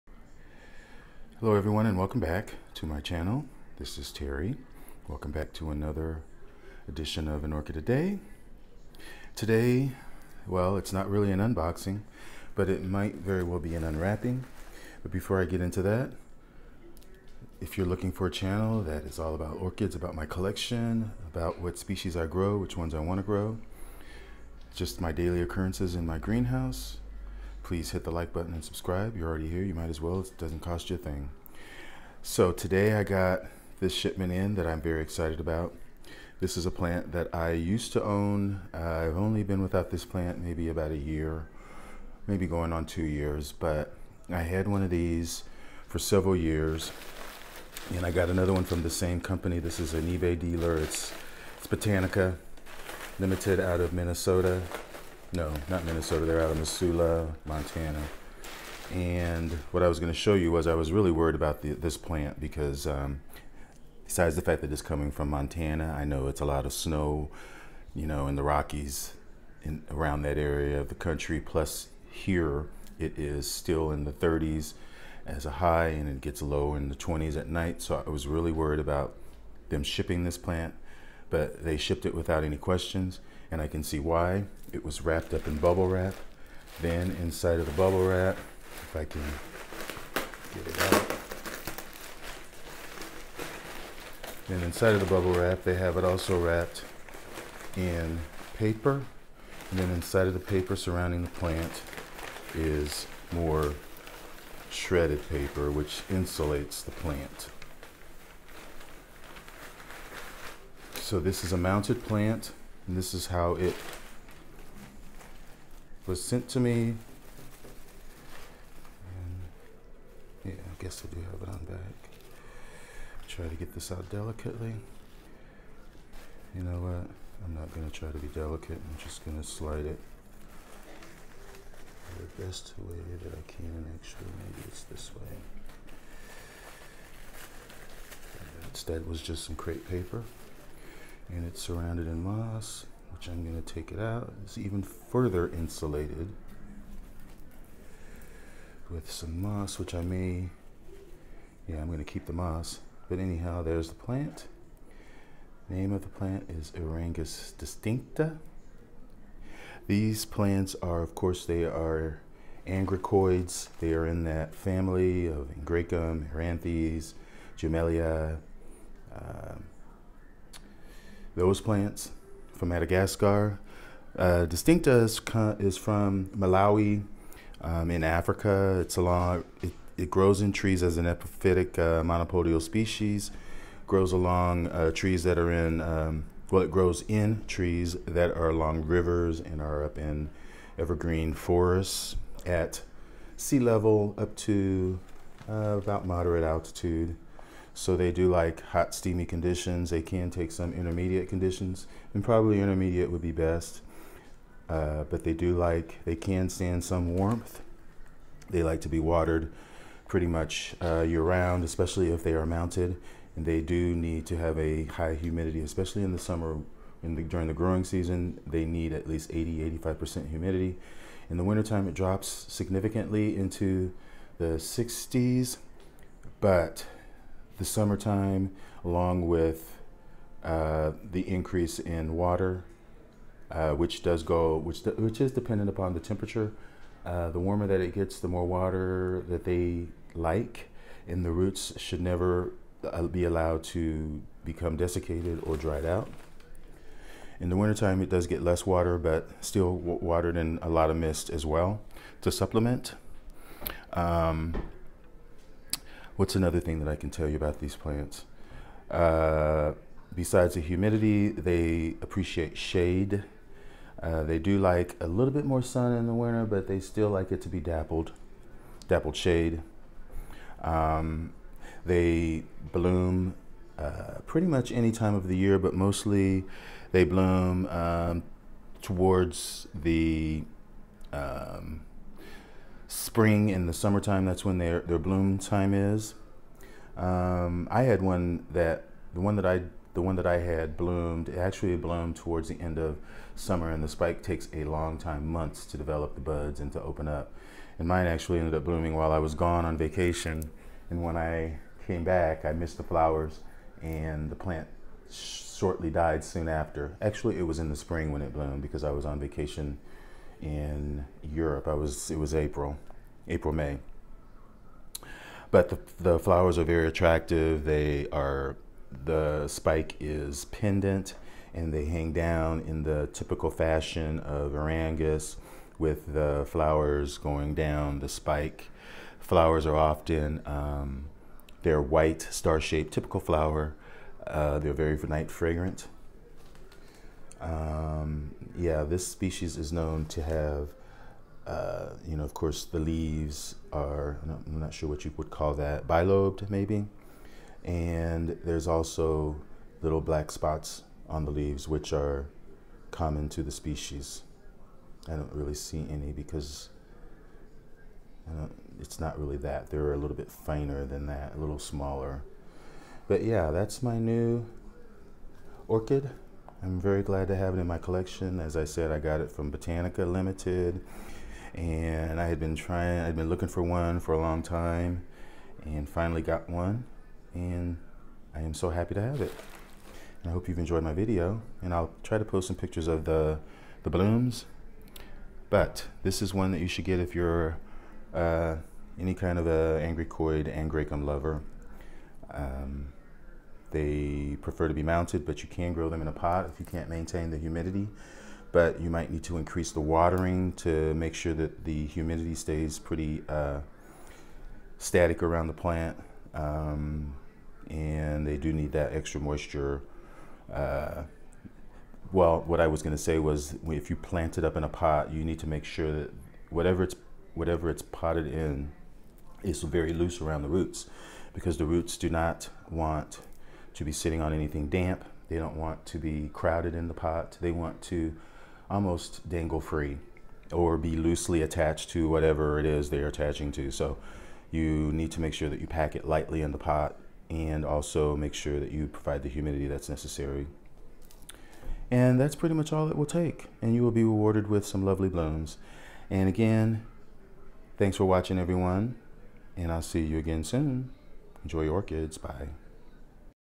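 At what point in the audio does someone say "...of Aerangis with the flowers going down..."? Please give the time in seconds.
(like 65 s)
324 s.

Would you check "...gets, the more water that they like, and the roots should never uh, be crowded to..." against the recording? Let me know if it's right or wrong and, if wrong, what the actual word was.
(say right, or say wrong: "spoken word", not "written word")
wrong: "allowed", not "crowded".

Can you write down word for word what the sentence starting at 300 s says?
And when I came back, I missed the flowers, and the plant shortly died soon after.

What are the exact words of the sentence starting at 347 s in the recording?
And there's also little black spots on the leaves, which are common to the species.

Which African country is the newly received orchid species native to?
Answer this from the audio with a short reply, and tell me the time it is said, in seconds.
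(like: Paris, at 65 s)
Malawi, at 176 s.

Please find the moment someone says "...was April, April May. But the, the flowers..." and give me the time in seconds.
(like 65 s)
312 s.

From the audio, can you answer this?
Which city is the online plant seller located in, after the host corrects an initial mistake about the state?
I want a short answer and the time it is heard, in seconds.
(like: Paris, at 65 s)
Missoula, Montana, at 56 s.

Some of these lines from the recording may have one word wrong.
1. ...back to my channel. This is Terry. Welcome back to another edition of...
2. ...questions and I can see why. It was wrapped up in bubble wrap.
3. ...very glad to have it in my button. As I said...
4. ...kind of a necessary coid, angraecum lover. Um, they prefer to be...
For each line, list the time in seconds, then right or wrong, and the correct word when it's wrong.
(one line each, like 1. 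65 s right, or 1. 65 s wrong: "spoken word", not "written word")
1. 2 s right
2. 82 s right
3. 366 s wrong: "collection", not "button"
4. 389 s wrong: "angry", not "necessary".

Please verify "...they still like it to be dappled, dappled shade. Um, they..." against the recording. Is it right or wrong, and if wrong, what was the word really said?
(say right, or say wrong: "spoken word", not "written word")
right.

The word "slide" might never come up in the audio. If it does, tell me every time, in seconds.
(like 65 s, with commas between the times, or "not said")
129 s.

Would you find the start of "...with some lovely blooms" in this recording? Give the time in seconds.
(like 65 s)
444 s.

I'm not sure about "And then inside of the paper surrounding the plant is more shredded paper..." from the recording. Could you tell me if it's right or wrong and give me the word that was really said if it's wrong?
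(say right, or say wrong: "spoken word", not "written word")
right.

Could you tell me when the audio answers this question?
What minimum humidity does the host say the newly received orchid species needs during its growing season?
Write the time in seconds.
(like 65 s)
219 s.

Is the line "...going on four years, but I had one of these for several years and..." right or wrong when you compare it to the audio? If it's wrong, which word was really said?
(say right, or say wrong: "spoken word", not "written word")
wrong: "two", not "four".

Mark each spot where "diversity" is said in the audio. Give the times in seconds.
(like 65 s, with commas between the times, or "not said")
not said.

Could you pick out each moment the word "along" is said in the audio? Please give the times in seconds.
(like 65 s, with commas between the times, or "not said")
178 s, 184 s, 188 s, 228 s.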